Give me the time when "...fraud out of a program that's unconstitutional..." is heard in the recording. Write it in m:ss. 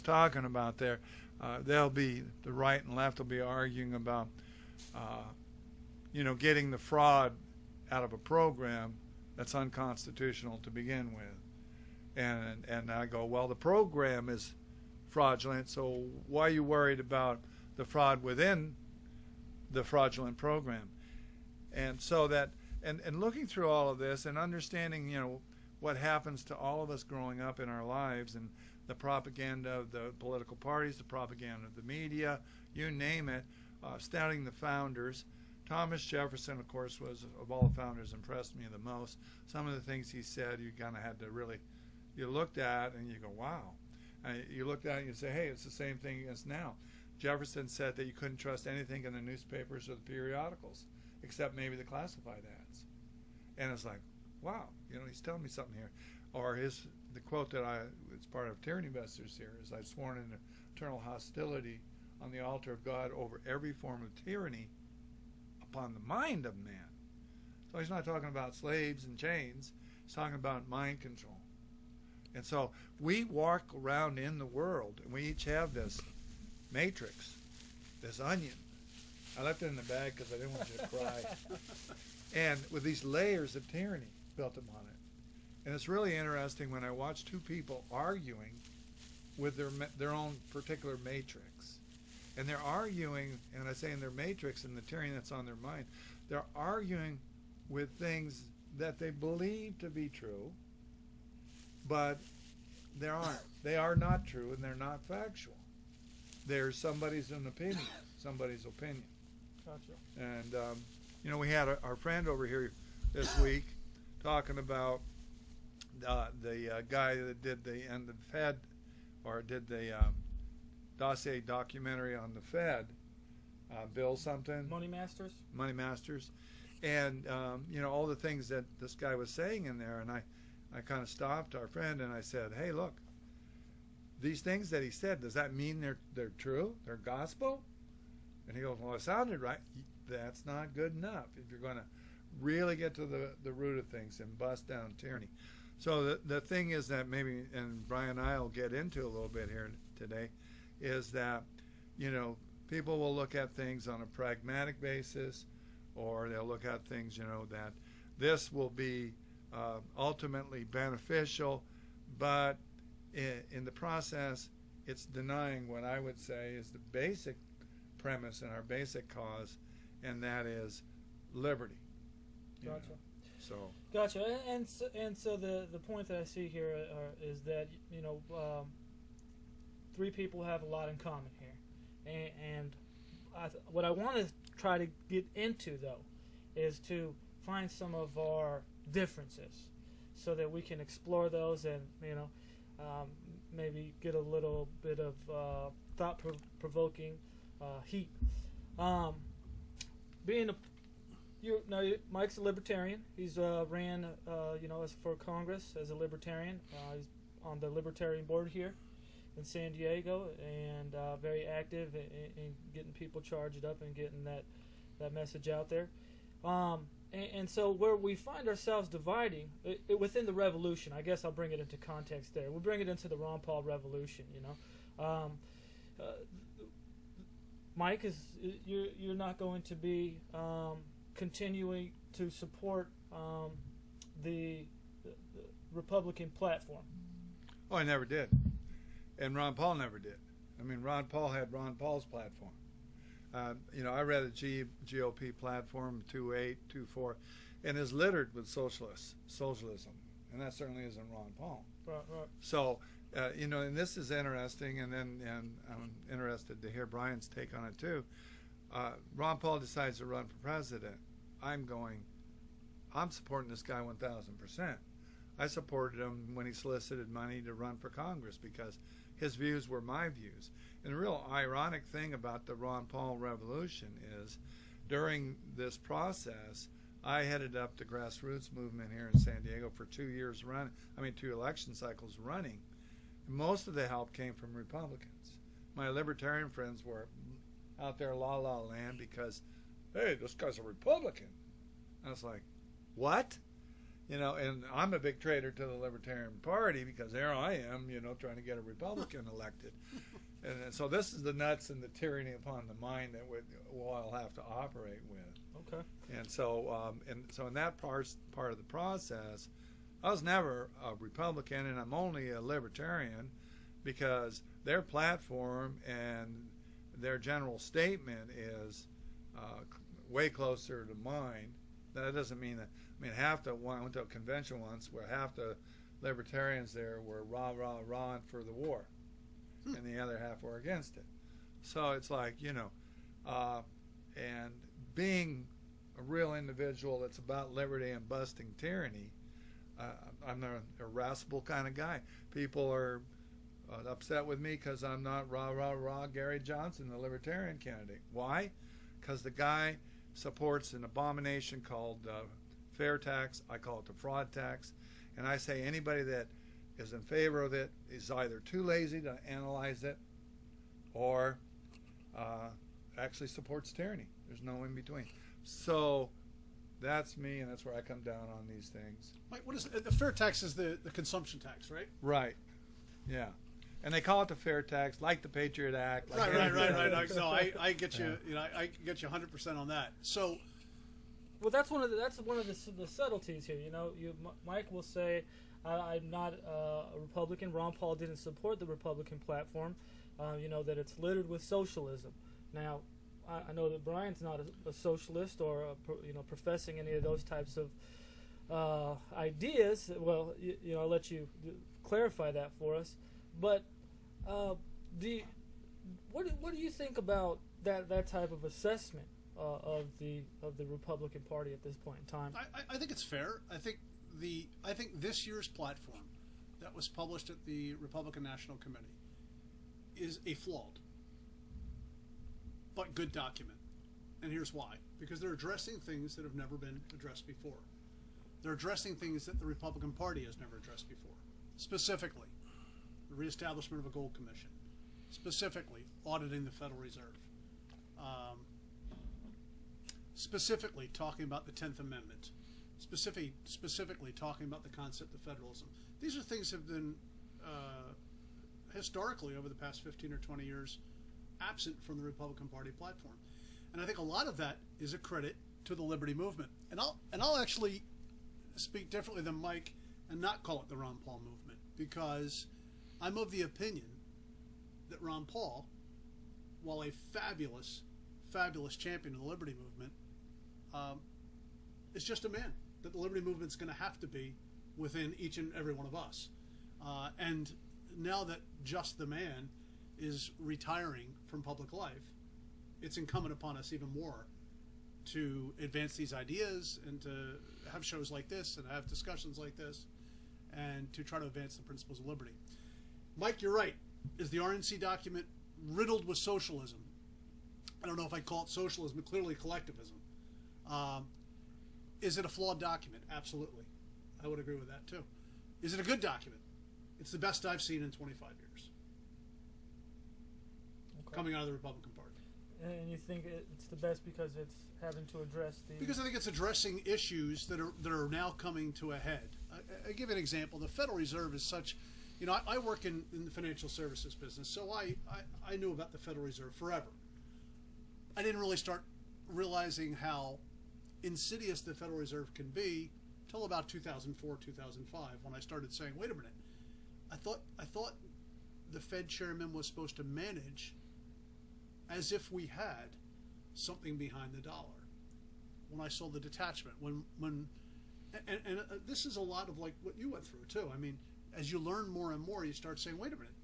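0:06.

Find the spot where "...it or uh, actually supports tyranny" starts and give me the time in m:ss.
5:59.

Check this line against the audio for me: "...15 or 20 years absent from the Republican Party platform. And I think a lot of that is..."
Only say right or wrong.
right.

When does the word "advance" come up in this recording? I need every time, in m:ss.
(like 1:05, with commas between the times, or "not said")
8:05, 8:11.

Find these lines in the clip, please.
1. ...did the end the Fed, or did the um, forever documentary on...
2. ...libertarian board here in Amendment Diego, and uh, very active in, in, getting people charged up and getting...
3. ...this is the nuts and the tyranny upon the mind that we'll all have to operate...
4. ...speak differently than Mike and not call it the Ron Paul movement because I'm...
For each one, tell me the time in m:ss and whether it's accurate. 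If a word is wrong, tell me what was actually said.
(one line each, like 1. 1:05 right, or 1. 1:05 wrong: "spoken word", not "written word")
1. 1:57 wrong: "dossier", not "forever"
2. 3:27 wrong: "San", not "Amendment"
3. 5:00 right
4. 7:38 right.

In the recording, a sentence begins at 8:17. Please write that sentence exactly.
I don't know if I'd call it socialism, but clearly collectivism.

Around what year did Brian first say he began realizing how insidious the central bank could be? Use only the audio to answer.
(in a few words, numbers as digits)
2004.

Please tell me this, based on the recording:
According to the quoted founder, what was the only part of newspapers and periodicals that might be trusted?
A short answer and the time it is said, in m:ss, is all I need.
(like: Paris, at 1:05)
classified ads, at 0:51.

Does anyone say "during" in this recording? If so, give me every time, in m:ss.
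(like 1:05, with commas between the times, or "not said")
4:34.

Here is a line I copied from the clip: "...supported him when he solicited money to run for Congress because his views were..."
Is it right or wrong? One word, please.
right.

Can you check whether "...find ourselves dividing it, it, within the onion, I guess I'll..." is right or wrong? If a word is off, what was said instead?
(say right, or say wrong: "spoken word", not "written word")
wrong: "revolution", not "onion".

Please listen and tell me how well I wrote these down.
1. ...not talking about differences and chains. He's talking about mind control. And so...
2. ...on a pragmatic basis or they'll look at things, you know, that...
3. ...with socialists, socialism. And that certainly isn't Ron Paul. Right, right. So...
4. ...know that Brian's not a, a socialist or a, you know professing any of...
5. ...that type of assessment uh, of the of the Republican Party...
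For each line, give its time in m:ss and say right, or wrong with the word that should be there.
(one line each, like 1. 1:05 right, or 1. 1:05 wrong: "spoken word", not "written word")
1. 1:07 wrong: "slaves", not "differences"
2. 2:33 right
3. 4:08 right
4. 6:33 right
5. 6:47 right.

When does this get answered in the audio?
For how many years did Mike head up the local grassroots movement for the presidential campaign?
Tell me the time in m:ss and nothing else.
4:39.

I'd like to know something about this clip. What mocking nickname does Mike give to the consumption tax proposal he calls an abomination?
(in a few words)
fraud tax.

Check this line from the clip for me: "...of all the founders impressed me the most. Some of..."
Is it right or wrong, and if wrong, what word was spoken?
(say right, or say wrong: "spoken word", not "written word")
right.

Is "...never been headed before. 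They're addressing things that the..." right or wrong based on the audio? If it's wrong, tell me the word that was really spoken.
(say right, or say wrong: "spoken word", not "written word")
wrong: "addressed", not "headed".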